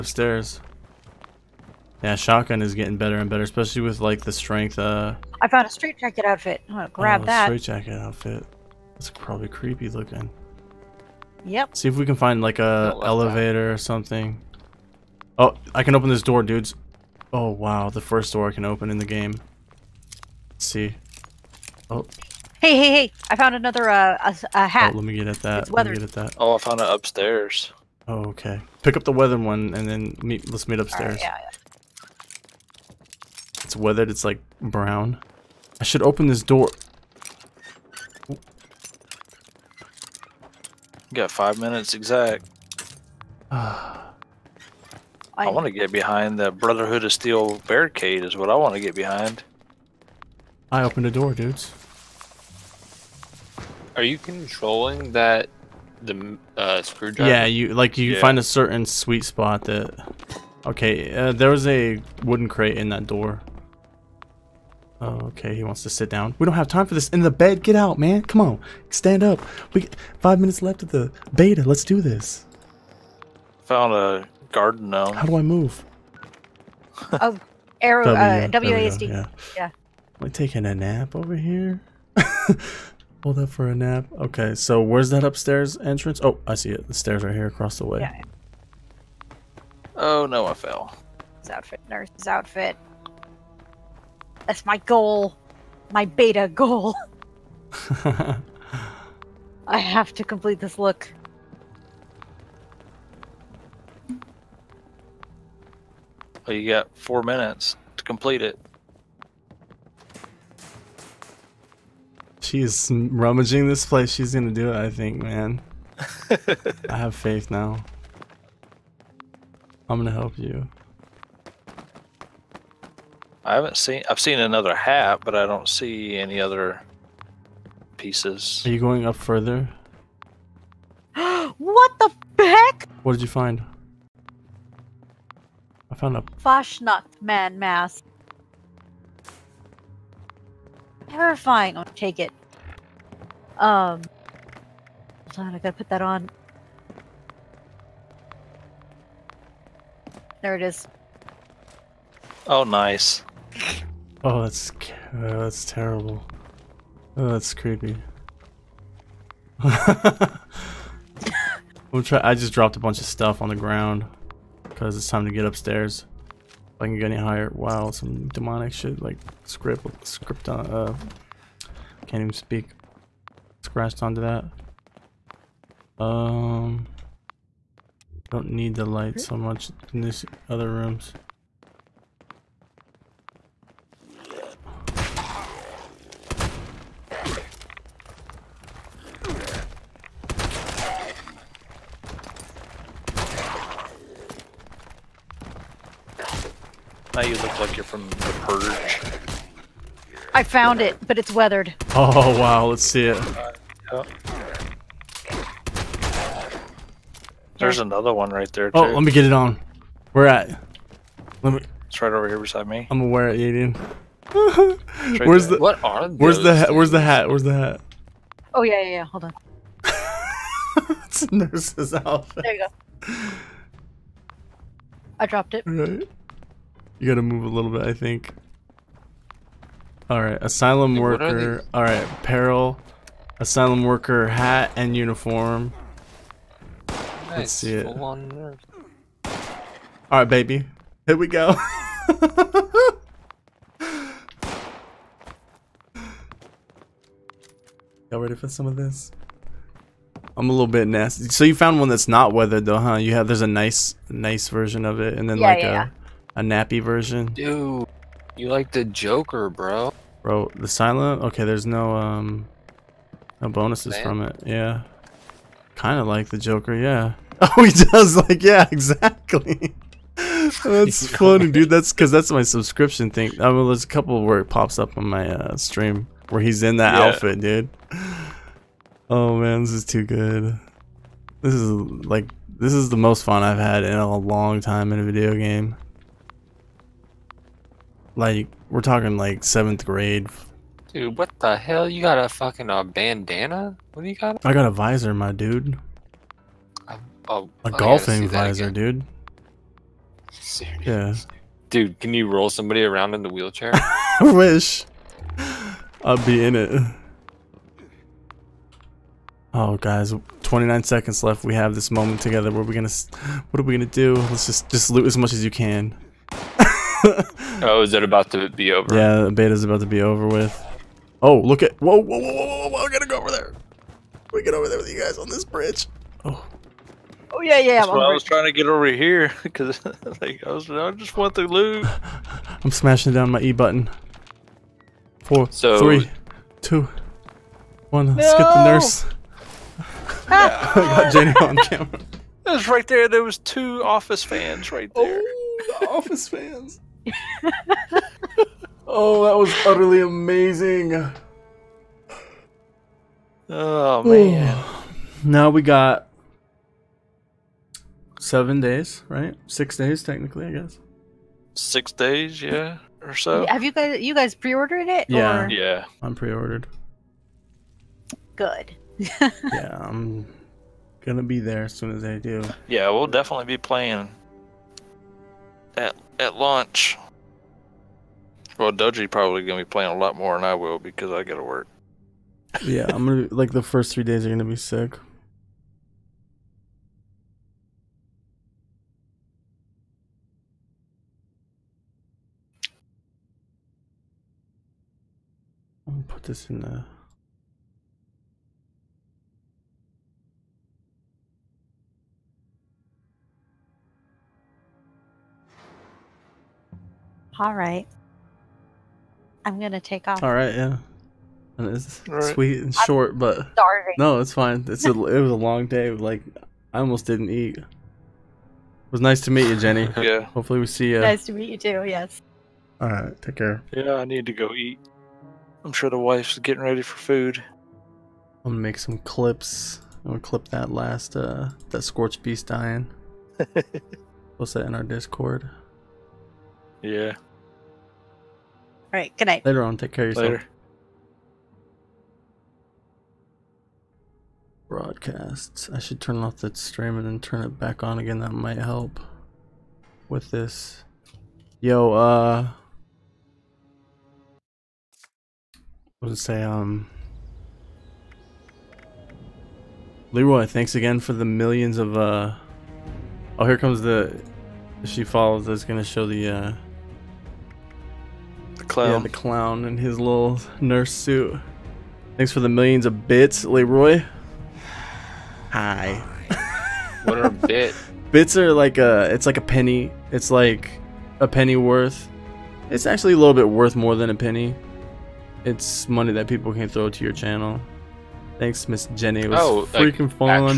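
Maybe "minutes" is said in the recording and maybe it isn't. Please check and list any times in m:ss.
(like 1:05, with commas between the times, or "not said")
0:41, 1:10, 1:47.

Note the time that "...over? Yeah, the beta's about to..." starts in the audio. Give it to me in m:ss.
5:18.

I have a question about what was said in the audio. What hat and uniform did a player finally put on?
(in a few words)
Asylum worker hat and uniform.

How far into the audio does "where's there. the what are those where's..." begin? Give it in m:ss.
3:35.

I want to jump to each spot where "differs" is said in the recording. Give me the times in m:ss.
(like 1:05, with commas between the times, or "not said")
not said.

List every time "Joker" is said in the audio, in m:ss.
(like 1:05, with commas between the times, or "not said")
4:18, 4:26.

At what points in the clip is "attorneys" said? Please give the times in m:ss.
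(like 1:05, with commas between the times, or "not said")
not said.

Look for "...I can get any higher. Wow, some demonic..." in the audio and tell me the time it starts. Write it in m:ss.
2:46.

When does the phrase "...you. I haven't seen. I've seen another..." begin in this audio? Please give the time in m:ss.
2:00.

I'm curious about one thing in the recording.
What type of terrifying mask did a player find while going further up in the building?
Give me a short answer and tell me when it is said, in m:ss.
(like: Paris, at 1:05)
Fasnacht man mask, at 2:16.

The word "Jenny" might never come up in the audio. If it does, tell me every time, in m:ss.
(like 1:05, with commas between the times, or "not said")
5:41, 6:59, 8:08.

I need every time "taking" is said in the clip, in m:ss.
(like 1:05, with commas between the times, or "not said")
1:20.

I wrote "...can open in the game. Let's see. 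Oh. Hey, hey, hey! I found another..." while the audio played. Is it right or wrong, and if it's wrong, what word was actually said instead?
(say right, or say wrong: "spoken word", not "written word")
right.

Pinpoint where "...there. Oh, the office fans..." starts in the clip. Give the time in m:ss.
5:44.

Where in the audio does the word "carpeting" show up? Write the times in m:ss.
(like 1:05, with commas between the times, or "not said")
not said.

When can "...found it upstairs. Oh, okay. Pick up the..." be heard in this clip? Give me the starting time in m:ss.
0:26.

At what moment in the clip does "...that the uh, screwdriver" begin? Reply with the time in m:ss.
0:55.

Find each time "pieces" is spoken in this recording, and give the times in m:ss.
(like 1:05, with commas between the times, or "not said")
2:07.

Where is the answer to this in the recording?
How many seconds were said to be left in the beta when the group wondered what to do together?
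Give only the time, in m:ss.
5:10.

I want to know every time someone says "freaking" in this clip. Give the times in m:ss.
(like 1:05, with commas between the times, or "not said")
8:09.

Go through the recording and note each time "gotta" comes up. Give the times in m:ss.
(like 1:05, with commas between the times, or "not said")
2:25, 3:47, 5:22, 6:21.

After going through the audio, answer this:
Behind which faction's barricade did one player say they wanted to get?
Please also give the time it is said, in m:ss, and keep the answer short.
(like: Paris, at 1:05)
Brotherhood of Steel, at 0:46.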